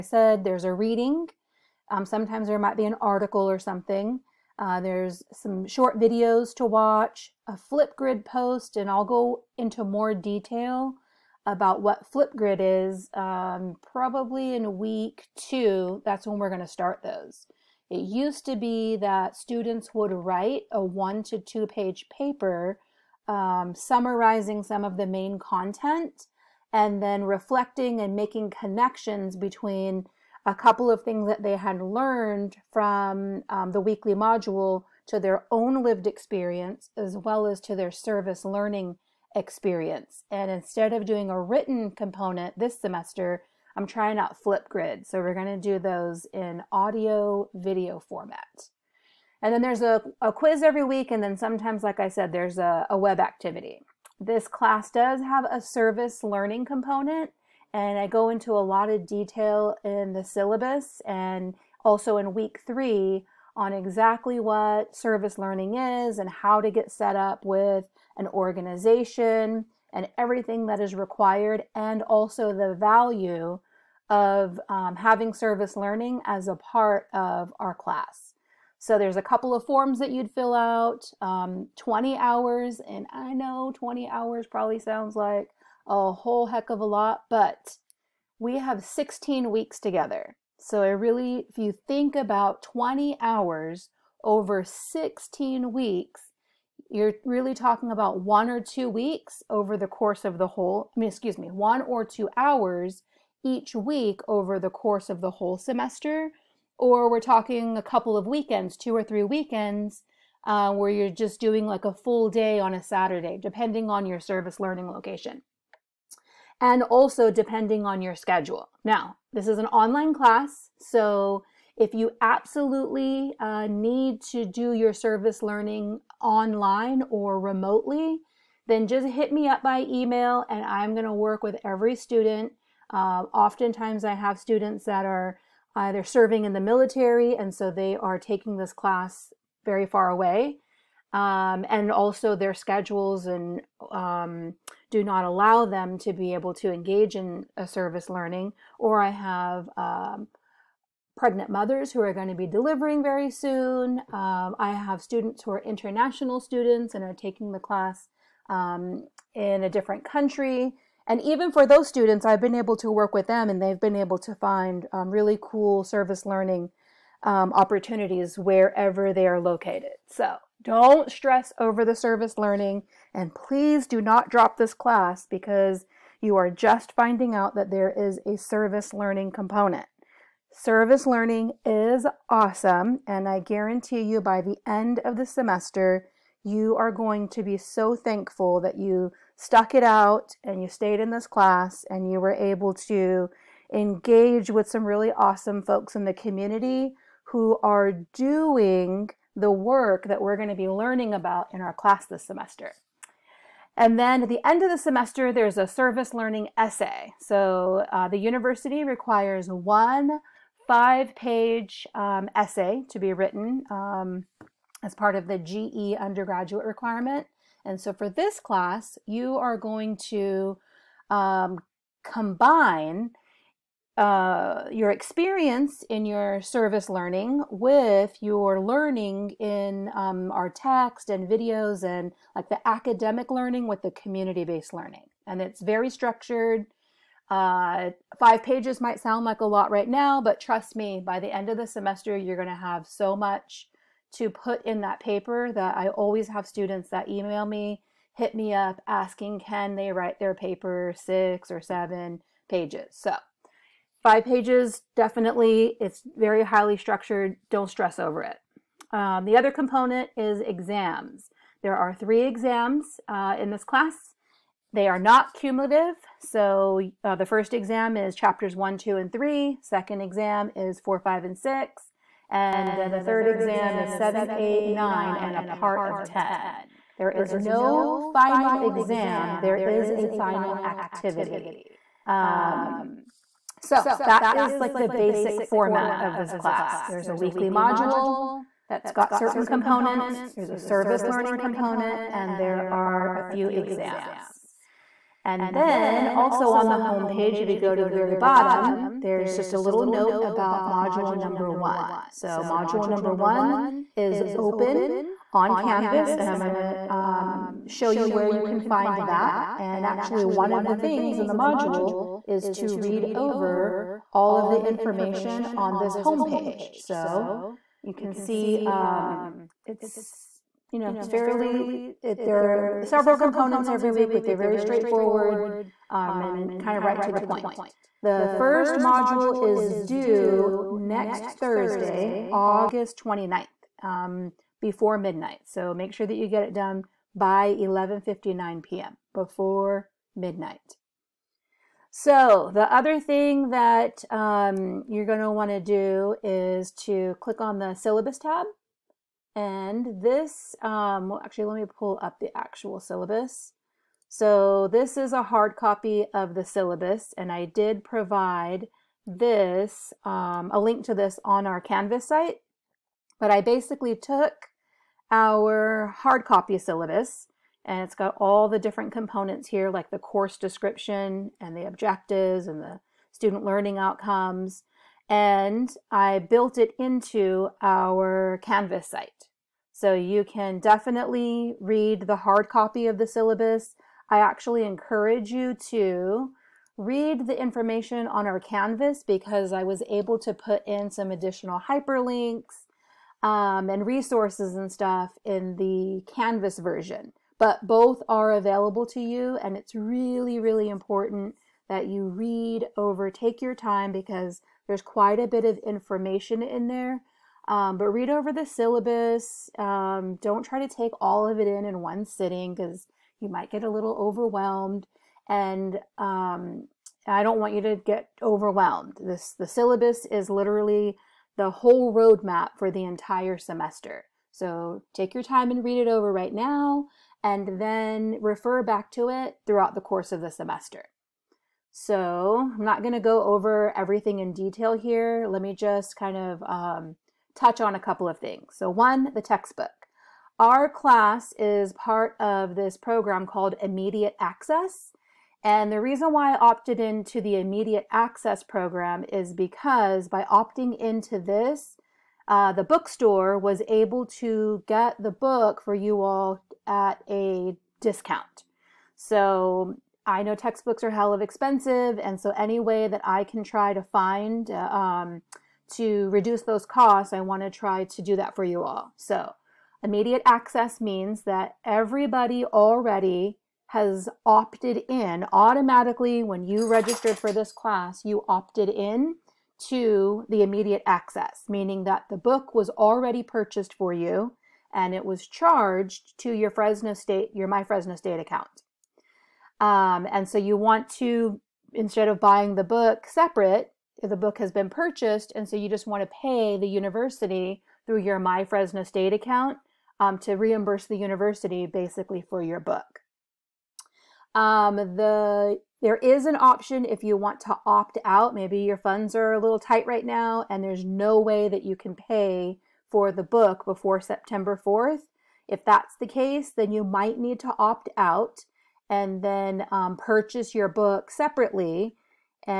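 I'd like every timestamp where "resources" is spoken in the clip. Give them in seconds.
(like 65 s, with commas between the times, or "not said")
393 s.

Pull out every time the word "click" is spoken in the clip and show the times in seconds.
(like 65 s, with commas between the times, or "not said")
347 s.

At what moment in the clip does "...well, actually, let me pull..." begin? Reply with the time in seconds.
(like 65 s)
351 s.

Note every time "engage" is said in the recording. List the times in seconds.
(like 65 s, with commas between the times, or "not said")
146 s, 193 s.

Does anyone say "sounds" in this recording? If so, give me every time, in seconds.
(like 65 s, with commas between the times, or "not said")
84 s, 238 s.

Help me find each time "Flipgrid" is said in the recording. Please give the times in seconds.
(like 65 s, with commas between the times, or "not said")
7 s, 12 s, 44 s.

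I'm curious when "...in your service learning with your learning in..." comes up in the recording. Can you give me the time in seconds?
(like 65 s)
225 s.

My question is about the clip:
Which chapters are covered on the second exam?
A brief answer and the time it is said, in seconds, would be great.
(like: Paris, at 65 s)
4, 5, and 6, at 270 s.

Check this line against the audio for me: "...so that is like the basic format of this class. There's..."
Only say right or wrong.
right.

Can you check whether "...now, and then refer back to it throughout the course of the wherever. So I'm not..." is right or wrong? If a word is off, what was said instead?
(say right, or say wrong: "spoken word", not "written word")
wrong: "semester", not "wherever".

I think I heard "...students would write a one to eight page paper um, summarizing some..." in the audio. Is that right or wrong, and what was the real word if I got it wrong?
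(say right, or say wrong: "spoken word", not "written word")
wrong: "two", not "eight".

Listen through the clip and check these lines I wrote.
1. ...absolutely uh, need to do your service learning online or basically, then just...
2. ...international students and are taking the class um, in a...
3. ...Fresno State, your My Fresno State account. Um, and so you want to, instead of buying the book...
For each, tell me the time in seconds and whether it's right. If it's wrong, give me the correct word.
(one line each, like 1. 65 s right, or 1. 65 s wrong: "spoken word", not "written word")
1. 122 s wrong: "remotely", not "basically"
2. 155 s right
3. 486 s right.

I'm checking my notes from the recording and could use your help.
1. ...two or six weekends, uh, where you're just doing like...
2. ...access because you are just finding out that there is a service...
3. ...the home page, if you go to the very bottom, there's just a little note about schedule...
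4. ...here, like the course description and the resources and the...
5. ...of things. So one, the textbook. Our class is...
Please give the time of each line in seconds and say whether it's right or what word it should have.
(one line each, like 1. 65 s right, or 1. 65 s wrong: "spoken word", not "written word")
1. 108 s wrong: "three", not "six"
2. 174 s wrong: "class", not "access"
3. 296 s wrong: "module", not "schedule"
4. 369 s wrong: "objectives", not "resources"
5. 438 s right.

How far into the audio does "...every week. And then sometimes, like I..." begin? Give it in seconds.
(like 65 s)
50 s.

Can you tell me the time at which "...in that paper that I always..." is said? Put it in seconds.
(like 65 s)
244 s.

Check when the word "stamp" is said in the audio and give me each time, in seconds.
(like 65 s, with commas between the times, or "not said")
not said.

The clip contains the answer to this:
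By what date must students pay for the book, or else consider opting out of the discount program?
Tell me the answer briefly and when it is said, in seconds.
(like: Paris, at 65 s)
September 4th, at 514 s.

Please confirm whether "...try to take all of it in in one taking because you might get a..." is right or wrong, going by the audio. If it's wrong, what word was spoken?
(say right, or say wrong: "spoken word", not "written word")
wrong: "sitting", not "taking".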